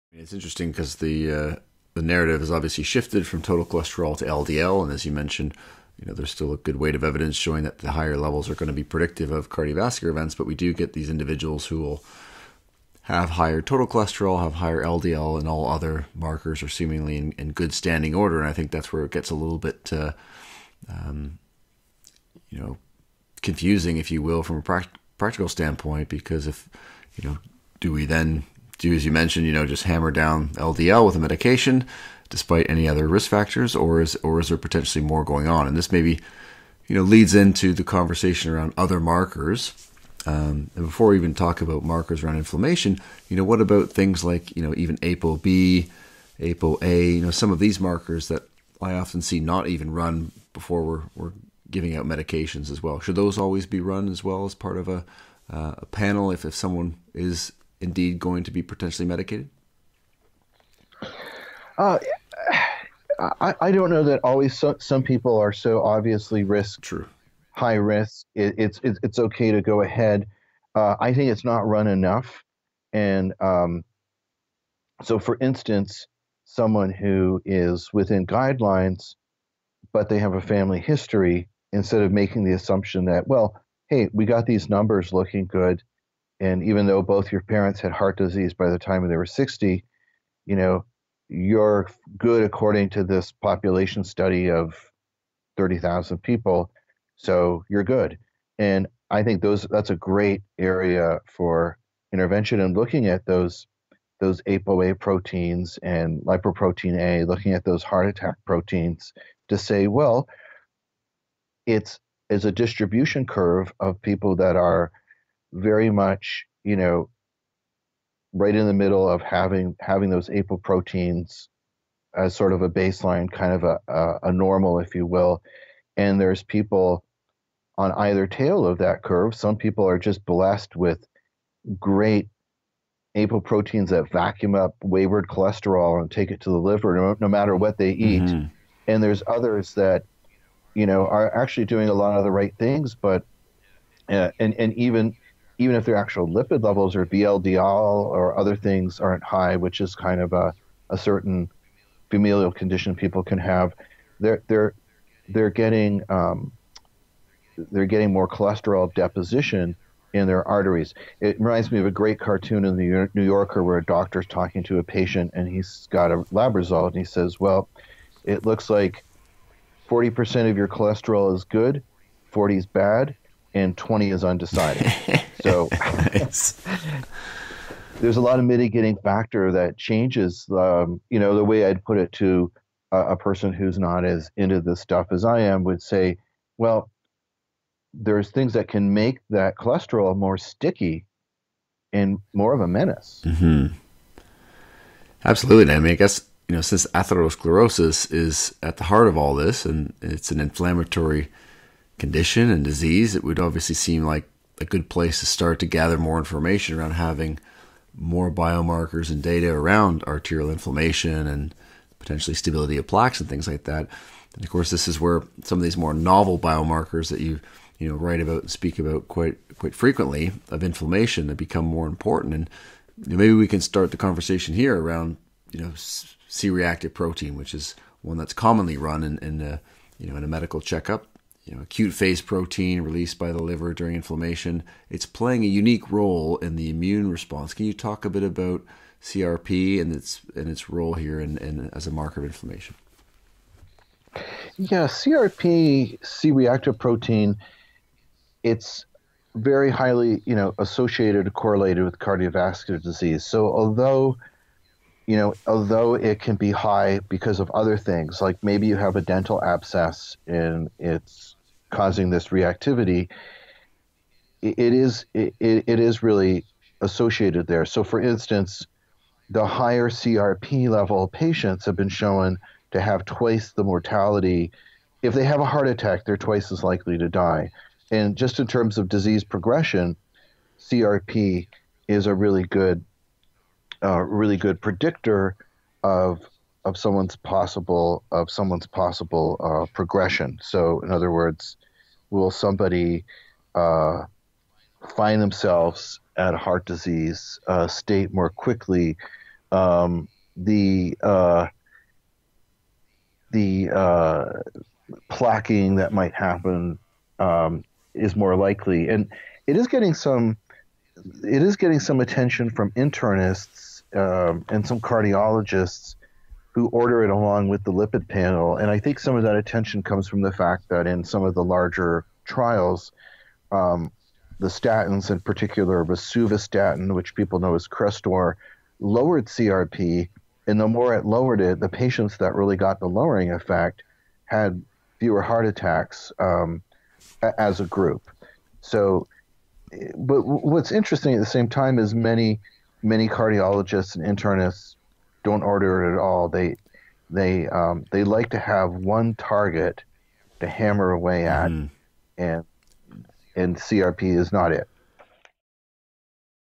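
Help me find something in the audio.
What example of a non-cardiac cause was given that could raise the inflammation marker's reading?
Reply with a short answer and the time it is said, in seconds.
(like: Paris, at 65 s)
dental abscess, at 259 s.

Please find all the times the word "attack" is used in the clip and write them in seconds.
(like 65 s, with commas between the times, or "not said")
108 s, 275 s, 335 s.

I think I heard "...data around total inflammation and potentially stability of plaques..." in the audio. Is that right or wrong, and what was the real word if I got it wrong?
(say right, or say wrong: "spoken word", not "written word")
wrong: "arterial", not "total".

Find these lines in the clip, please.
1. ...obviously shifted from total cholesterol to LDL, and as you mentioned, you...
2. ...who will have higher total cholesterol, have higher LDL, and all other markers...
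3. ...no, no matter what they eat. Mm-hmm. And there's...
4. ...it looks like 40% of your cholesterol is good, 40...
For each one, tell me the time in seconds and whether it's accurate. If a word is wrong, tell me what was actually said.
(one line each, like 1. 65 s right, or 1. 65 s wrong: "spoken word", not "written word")
1. 2 s right
2. 11 s right
3. 136 s right
4. 168 s right.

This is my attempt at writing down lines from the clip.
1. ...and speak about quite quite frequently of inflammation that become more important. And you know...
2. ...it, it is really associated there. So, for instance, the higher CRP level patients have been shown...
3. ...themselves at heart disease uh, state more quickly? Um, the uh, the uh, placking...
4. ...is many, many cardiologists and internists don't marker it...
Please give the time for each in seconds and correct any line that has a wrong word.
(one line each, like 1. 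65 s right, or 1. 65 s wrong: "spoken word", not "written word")
1. 218 s right
2. 265 s right
3. 295 s right
4. 341 s wrong: "order", not "marker".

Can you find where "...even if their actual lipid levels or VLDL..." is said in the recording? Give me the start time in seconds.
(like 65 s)
145 s.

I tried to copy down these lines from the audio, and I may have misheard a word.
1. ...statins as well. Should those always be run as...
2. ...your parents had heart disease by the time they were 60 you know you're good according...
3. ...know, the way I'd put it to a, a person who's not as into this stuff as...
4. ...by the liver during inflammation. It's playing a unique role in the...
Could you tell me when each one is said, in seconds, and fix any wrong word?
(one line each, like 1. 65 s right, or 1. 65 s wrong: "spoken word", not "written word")
1. 52 s wrong: "medications", not "statins"
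2. 87 s right
3. 181 s right
4. 233 s right.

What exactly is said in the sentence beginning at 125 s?
And there's people on either tail of that curve.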